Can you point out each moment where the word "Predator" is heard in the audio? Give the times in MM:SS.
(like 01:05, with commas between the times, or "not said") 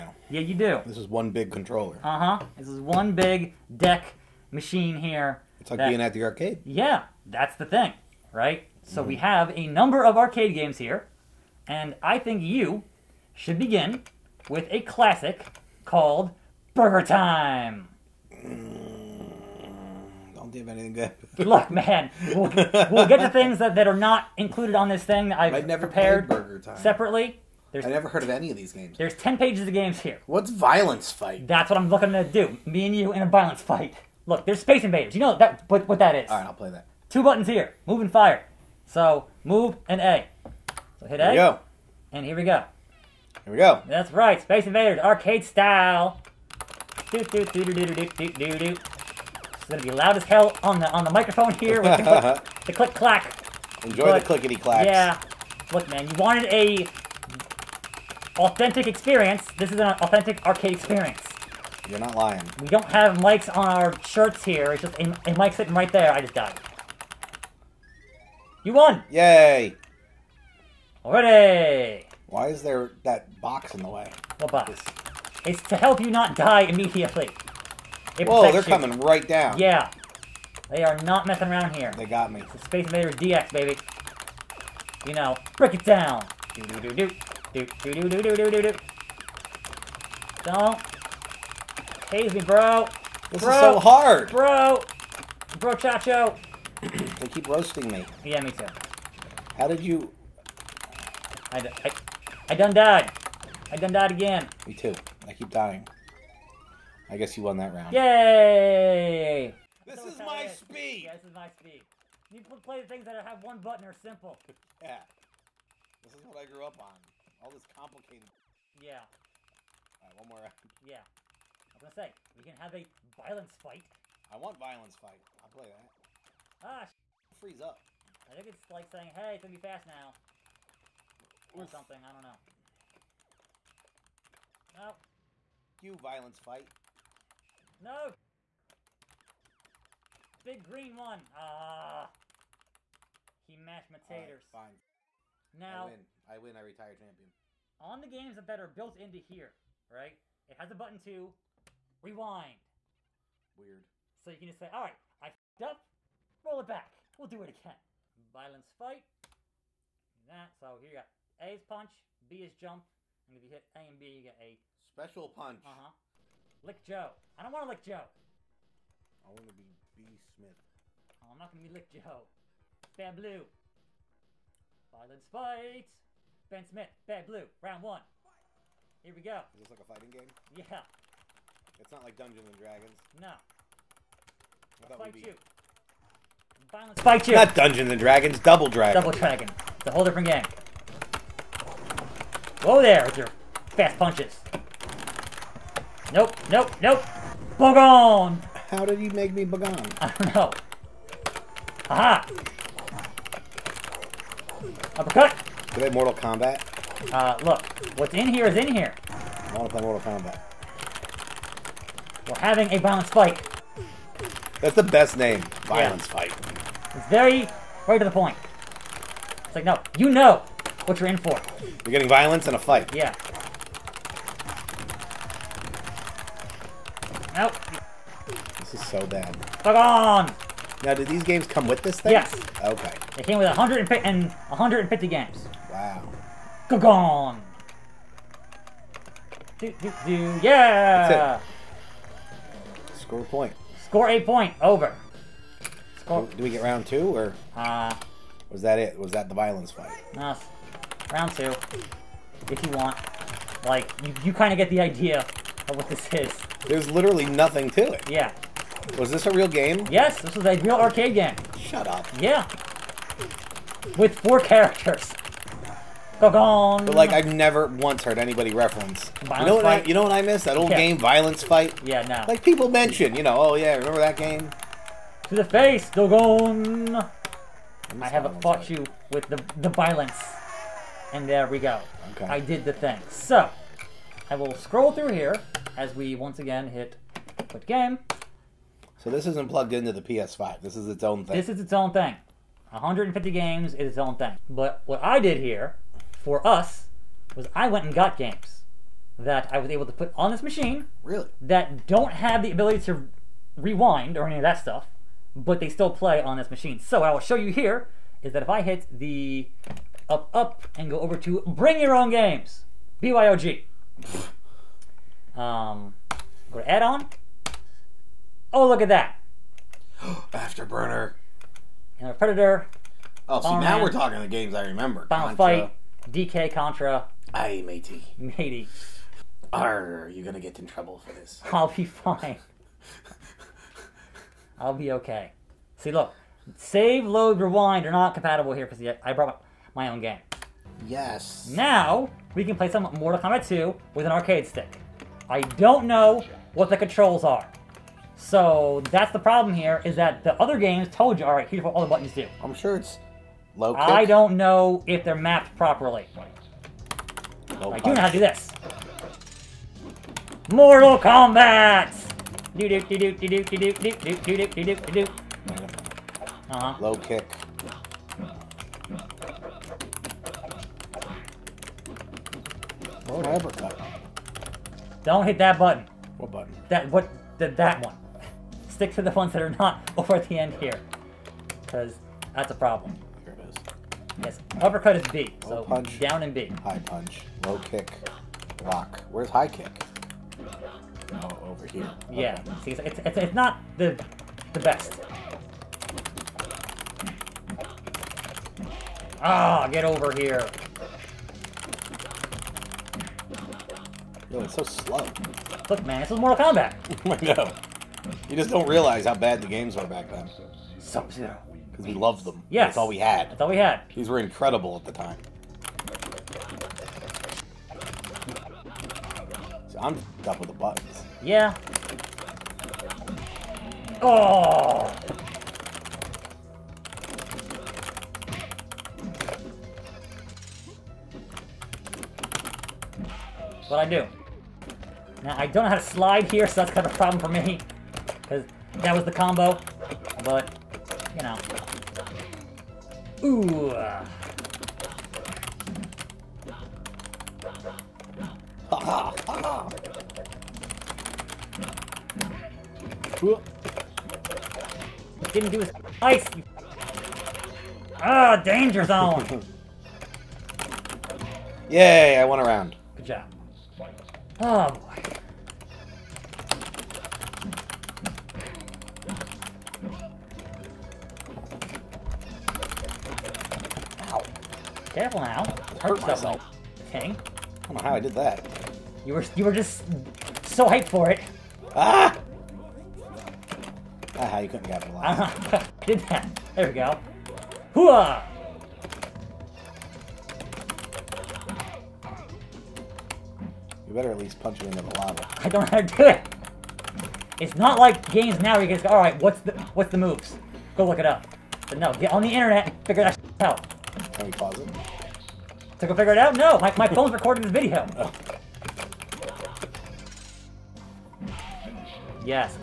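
05:22.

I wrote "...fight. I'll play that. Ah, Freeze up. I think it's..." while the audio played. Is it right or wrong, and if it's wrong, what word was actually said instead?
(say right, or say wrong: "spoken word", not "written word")
right.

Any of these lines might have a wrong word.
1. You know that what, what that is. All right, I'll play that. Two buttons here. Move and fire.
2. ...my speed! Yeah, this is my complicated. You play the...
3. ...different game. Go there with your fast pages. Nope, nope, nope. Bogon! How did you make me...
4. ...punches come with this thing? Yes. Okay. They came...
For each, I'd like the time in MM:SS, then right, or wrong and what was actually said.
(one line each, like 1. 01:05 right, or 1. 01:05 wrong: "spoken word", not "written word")
1. 00:35 right
2. 01:50 wrong: "speed", not "complicated"
3. 03:10 wrong: "punches", not "pages"
4. 03:51 wrong: "games", not "punches".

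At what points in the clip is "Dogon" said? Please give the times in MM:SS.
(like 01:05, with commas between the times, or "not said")
04:35.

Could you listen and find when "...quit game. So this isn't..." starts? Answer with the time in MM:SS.
04:47.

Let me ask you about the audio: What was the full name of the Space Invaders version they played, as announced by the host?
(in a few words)
Space Invaders DX.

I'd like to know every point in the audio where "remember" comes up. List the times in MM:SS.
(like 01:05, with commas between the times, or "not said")
04:33, 05:24.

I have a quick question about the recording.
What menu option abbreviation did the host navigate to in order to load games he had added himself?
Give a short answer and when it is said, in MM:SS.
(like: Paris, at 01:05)
BYOG, at 05:13.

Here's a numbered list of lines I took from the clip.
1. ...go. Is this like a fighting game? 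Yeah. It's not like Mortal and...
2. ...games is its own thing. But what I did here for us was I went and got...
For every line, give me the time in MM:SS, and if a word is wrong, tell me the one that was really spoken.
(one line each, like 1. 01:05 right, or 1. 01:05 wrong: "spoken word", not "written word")
1. 02:59 wrong: "Dungeons", not "Mortal"
2. 04:53 right.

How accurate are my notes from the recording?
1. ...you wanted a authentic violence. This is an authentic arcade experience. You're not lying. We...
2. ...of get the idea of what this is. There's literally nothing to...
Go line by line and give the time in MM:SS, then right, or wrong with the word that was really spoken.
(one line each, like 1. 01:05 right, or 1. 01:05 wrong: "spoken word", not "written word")
1. 00:56 wrong: "experience", not "violence"
2. 04:14 right.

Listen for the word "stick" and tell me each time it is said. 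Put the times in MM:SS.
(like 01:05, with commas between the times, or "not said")
05:44, 06:18.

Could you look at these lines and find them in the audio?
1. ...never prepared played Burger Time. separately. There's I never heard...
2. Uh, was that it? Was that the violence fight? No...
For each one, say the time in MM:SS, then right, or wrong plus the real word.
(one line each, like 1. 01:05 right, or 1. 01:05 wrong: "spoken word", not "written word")
1. 00:25 right
2. 04:07 right.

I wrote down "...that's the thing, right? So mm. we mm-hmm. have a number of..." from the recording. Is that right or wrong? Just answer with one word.
right.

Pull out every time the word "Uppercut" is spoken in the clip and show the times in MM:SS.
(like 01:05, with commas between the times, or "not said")
03:24, 06:24.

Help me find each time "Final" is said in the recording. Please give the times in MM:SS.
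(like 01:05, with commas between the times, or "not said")
05:25.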